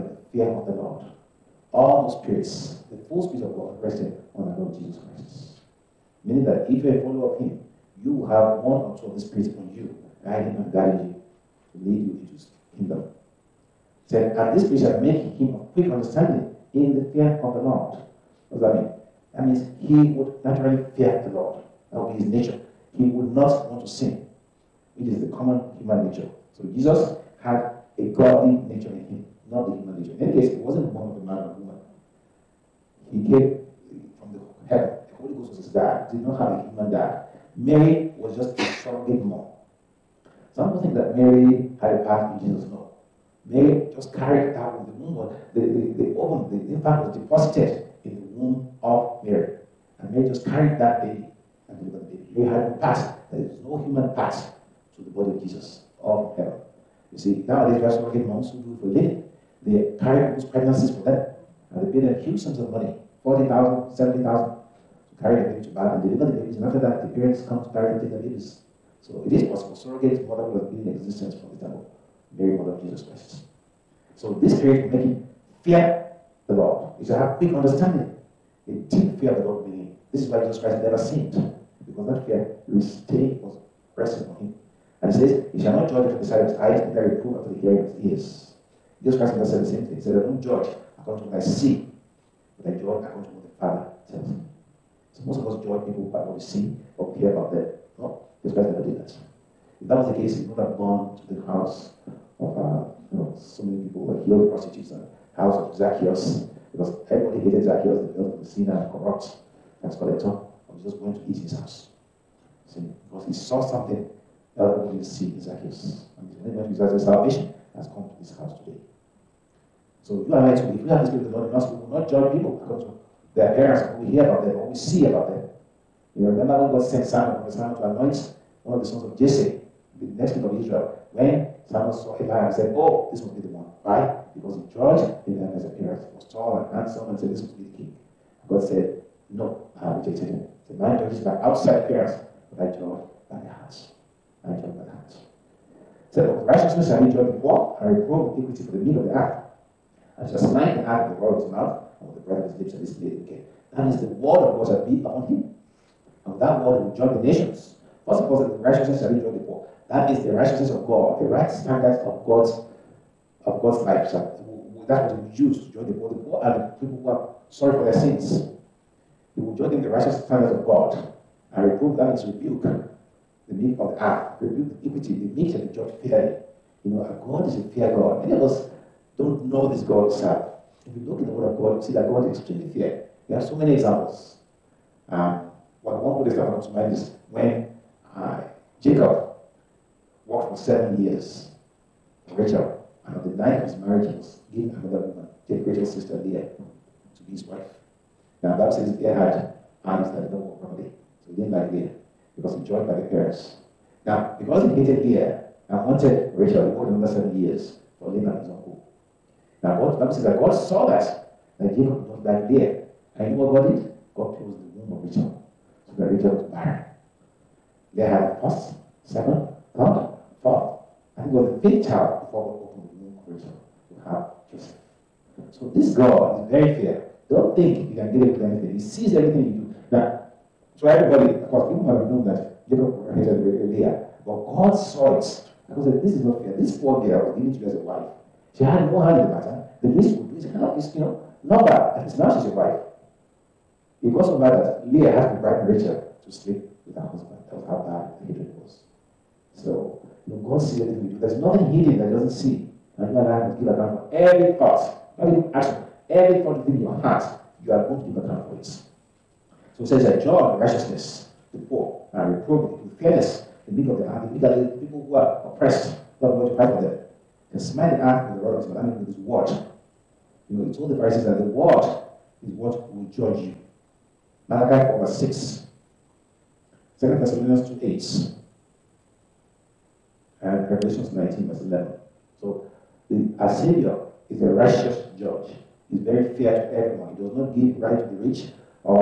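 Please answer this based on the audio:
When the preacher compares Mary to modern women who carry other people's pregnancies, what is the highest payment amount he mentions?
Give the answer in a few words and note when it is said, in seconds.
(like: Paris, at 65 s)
70,000, at 63 s.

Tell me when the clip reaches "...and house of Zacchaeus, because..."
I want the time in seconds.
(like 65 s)
104 s.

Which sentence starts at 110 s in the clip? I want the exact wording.
But Jesus went to eat in his house.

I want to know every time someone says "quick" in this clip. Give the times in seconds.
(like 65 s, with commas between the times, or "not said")
15 s, 77 s.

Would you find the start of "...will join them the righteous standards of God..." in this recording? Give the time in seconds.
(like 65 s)
169 s.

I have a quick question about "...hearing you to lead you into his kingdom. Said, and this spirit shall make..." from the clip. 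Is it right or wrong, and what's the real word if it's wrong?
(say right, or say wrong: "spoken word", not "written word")
wrong: "guiding", not "hearing".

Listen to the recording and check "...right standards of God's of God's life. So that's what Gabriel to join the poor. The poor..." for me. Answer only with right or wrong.
wrong.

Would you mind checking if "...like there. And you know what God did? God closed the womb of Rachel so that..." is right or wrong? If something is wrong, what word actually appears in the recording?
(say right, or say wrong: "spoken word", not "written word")
right.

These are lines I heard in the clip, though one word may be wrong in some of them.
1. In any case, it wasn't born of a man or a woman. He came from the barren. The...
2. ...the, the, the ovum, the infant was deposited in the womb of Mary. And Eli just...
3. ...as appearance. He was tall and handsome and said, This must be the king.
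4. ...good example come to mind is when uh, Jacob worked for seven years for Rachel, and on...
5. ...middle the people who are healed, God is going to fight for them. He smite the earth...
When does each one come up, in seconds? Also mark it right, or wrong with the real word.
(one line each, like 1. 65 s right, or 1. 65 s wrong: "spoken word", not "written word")
1. 30 s wrong: "heaven", not "barren"
2. 45 s wrong: "Mary", not "Eli"
3. 135 s right
4. 186 s right
5. 264 s wrong: "oppressed", not "healed".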